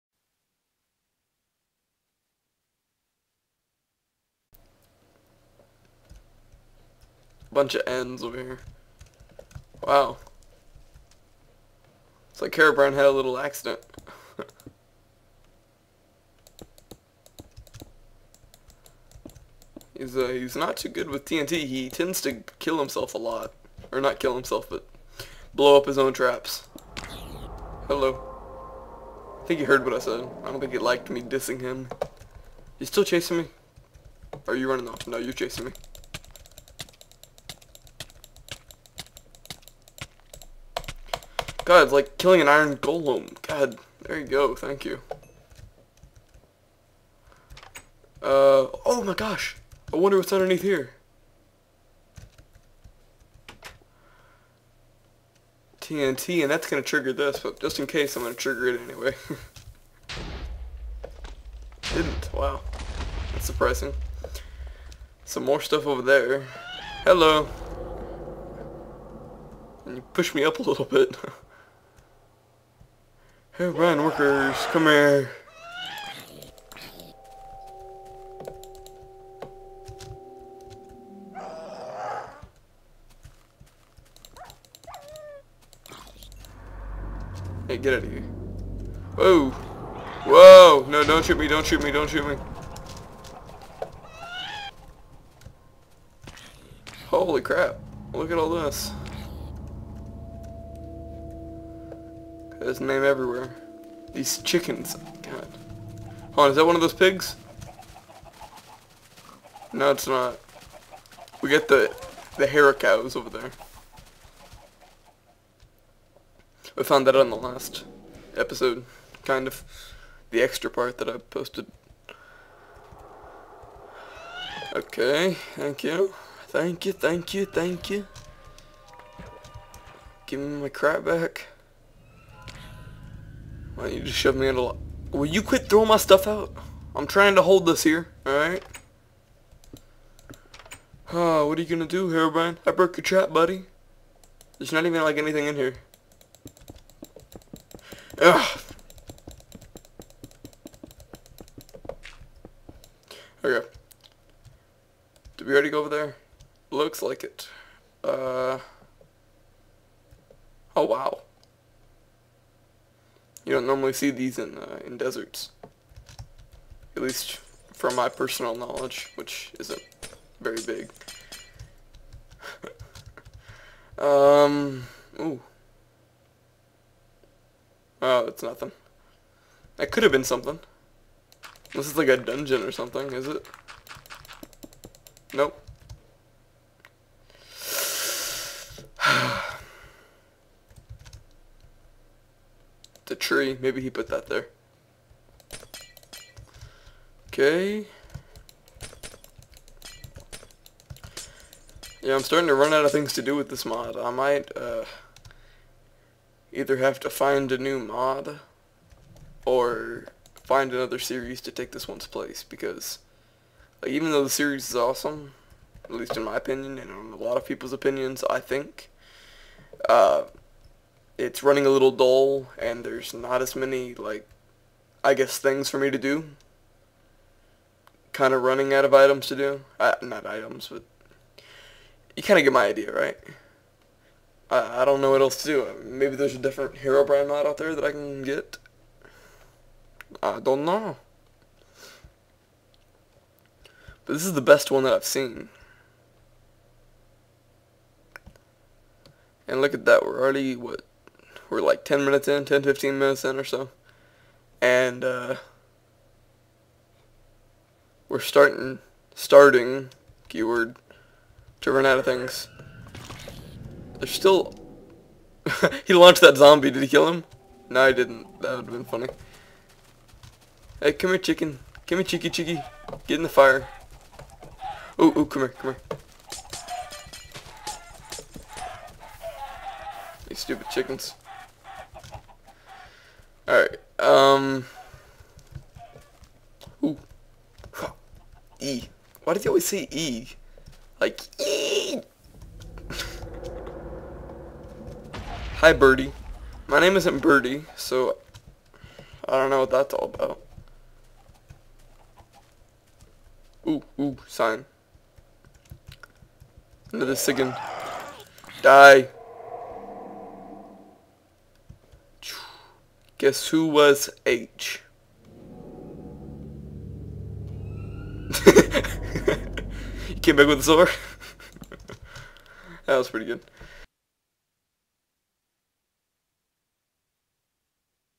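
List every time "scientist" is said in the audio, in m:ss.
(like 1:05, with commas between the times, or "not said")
not said.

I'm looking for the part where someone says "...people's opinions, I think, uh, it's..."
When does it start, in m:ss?
3:37.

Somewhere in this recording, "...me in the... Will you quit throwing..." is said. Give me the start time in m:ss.
2:14.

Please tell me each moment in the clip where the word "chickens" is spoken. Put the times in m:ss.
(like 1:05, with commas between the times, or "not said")
1:44, 4:31, 4:40.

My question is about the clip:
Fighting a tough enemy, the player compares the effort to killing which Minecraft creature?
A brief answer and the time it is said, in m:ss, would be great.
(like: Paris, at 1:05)
iron golem, at 0:42.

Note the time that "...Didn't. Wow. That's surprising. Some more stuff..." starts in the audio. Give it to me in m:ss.
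1:01.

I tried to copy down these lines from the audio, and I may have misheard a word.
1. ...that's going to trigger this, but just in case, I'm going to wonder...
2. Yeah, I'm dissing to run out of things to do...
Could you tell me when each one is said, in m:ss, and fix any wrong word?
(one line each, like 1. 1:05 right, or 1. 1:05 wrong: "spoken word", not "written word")
1. 0:56 wrong: "trigger", not "wonder"
2. 3:22 wrong: "starting", not "dissing".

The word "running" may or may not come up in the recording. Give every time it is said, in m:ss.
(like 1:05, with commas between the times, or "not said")
0:34, 3:41, 3:48.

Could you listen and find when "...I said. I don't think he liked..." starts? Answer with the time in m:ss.
0:29.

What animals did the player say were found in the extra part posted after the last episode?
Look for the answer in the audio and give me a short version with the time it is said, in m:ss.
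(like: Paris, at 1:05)
hera cows, at 1:52.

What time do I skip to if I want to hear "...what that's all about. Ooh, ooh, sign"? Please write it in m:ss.
4:59.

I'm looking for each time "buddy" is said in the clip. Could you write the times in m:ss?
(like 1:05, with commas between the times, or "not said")
2:23.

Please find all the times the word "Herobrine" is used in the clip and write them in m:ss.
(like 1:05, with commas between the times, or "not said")
0:12, 2:22, 3:56.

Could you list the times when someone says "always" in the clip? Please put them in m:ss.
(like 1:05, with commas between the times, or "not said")
4:49.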